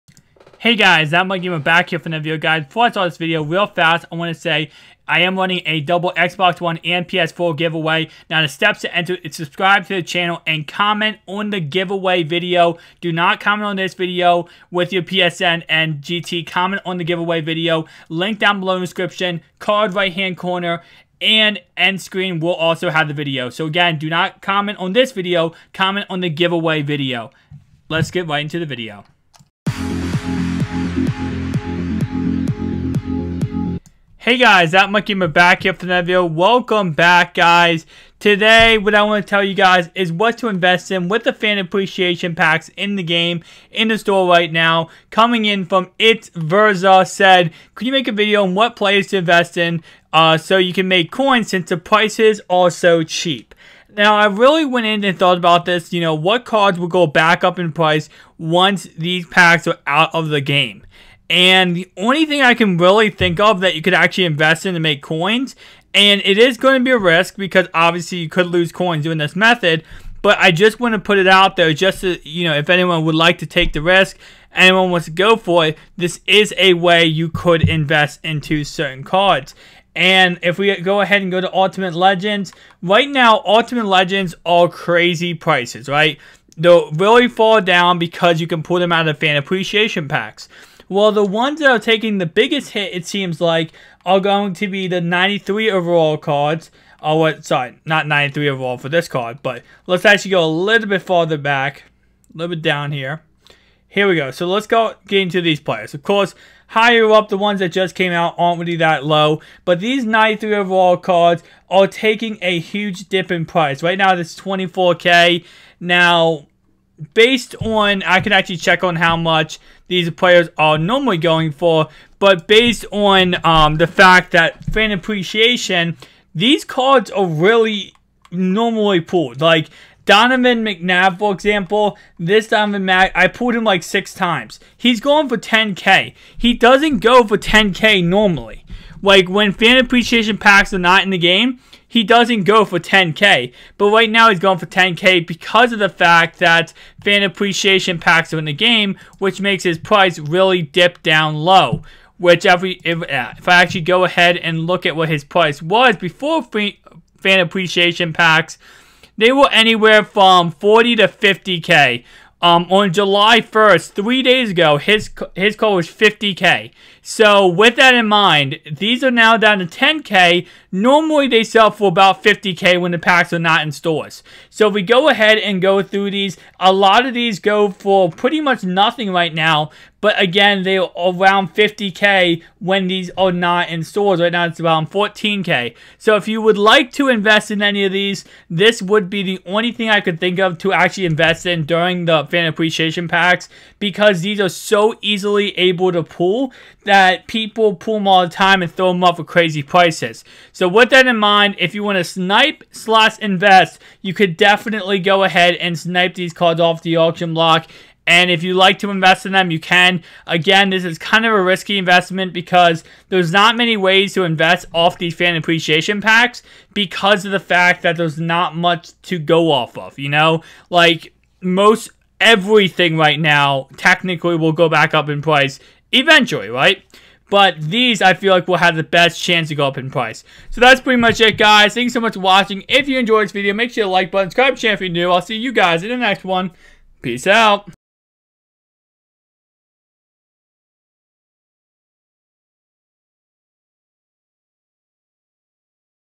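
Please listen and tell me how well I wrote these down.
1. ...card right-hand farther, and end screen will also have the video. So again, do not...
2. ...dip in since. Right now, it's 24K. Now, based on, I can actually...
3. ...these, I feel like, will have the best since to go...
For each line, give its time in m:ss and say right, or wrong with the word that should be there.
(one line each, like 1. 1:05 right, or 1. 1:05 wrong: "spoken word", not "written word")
1. 0:19 wrong: "corner", not "farther"
2. 1:53 wrong: "price", not "since"
3. 3:47 wrong: "chance", not "since".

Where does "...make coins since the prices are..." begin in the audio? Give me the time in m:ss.
0:50.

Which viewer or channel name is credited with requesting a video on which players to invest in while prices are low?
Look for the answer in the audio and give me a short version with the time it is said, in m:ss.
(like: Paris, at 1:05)
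It's Verza, at 0:45.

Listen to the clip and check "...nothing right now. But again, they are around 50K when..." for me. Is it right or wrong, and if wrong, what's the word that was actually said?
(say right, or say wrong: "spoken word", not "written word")
right.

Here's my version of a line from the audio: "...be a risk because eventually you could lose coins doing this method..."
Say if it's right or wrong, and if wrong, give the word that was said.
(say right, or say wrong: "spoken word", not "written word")
wrong: "obviously", not "eventually".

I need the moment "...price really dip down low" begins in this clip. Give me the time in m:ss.
2:29.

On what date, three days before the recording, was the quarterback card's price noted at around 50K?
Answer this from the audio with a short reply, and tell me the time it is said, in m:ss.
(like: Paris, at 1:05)
July 1st, at 2:42.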